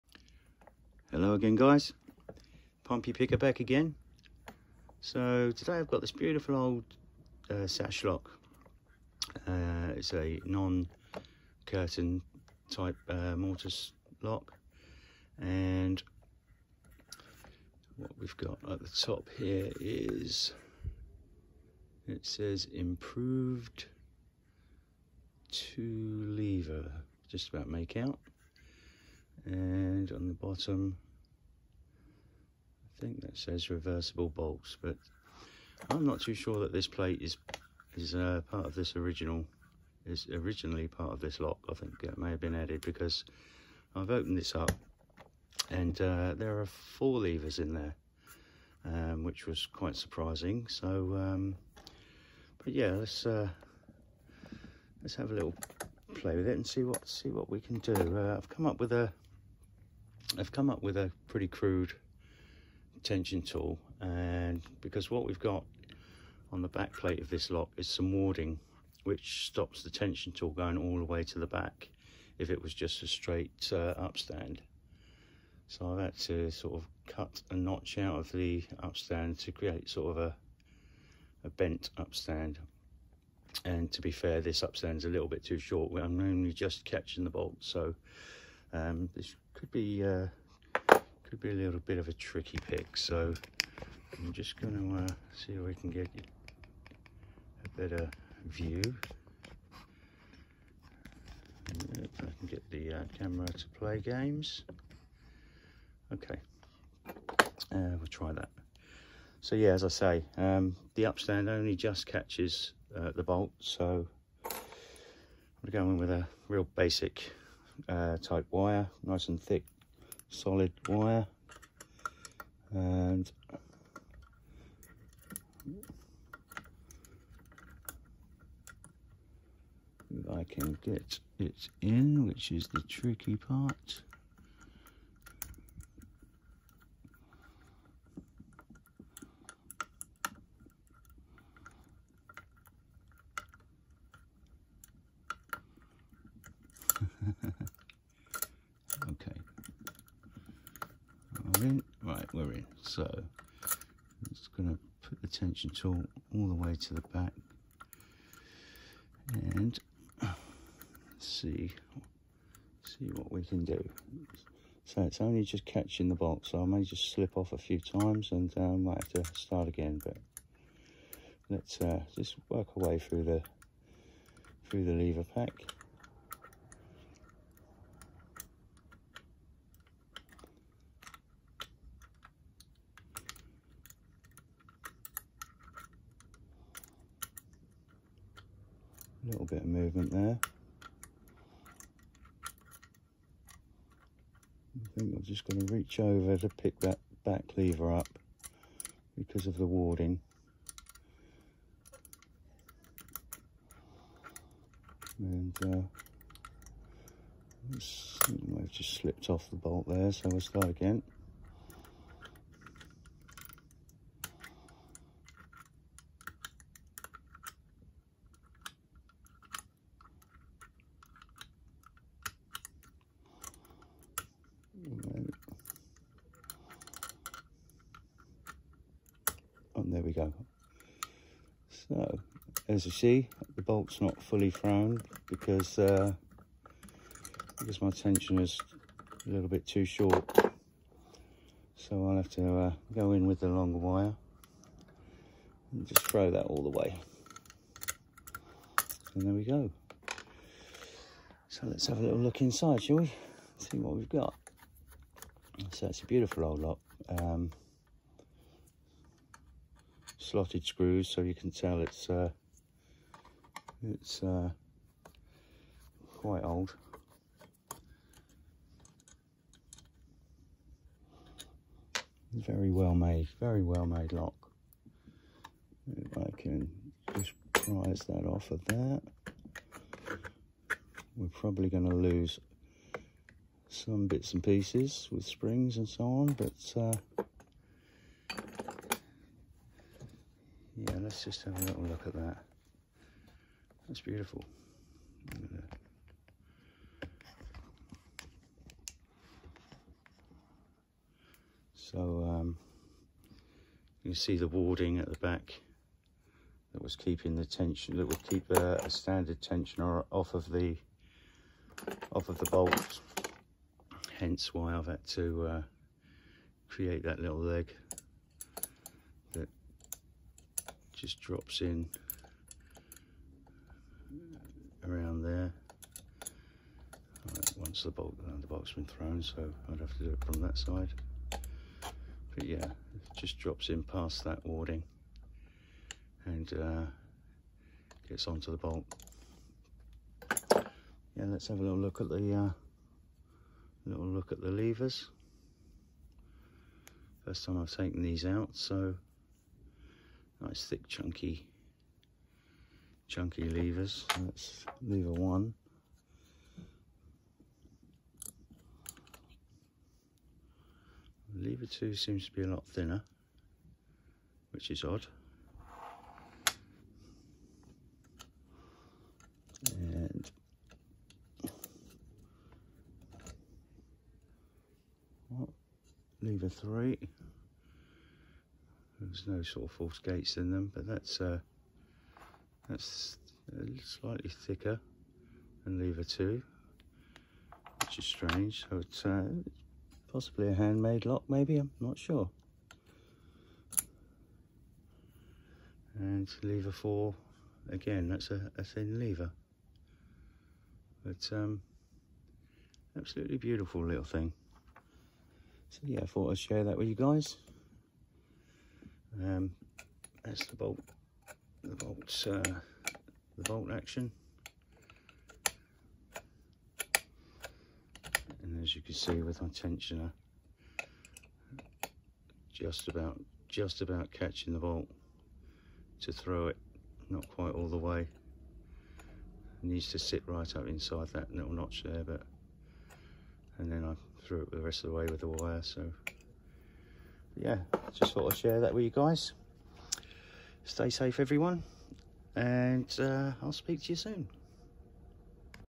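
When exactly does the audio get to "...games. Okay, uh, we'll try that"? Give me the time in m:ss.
1:43.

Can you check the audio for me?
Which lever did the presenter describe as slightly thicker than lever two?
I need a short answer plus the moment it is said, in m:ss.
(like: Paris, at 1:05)
Lever three, at 6:16.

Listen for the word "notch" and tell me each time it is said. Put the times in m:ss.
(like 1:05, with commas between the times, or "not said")
1:17, 7:11.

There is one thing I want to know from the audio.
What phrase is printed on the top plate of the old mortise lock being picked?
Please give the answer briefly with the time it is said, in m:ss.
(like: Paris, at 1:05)
Improved two lever, at 0:22.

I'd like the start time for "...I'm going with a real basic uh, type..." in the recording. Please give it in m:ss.
1:54.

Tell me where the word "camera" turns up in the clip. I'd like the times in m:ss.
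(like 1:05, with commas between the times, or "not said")
1:43.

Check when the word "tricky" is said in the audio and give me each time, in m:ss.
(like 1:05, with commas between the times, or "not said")
1:32, 2:12.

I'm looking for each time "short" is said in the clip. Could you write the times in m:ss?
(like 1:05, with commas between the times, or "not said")
1:25, 3:59.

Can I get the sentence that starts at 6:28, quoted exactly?
So it's uh, possibly a handmade lock, maybe, I'm not sure.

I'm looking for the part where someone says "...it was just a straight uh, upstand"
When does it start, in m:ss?
1:12.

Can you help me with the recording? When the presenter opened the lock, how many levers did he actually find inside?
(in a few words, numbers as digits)
4.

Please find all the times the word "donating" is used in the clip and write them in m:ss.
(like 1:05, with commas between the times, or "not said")
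not said.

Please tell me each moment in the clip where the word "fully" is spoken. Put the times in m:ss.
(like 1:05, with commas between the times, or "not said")
3:54.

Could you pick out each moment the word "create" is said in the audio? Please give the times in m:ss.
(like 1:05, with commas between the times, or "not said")
1:19, 5:16.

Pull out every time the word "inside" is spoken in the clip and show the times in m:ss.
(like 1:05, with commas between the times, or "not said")
4:12, 7:10.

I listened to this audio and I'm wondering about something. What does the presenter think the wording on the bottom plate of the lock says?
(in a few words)
Reversible bolts.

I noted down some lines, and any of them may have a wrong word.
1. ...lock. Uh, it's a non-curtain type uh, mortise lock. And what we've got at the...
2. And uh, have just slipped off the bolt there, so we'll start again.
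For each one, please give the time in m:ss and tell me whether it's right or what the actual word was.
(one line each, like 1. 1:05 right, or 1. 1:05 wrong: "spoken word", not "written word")
1. 0:08 right
2. 3:25 right.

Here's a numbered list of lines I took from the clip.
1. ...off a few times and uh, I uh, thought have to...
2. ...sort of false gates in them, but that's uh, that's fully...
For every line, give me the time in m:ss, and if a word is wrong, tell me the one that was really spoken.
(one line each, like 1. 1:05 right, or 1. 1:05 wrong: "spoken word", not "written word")
1. 2:47 wrong: "might", not "thought"
2. 6:19 wrong: "slightly", not "fully".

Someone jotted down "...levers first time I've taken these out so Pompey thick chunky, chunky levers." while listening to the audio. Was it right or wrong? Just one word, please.
wrong.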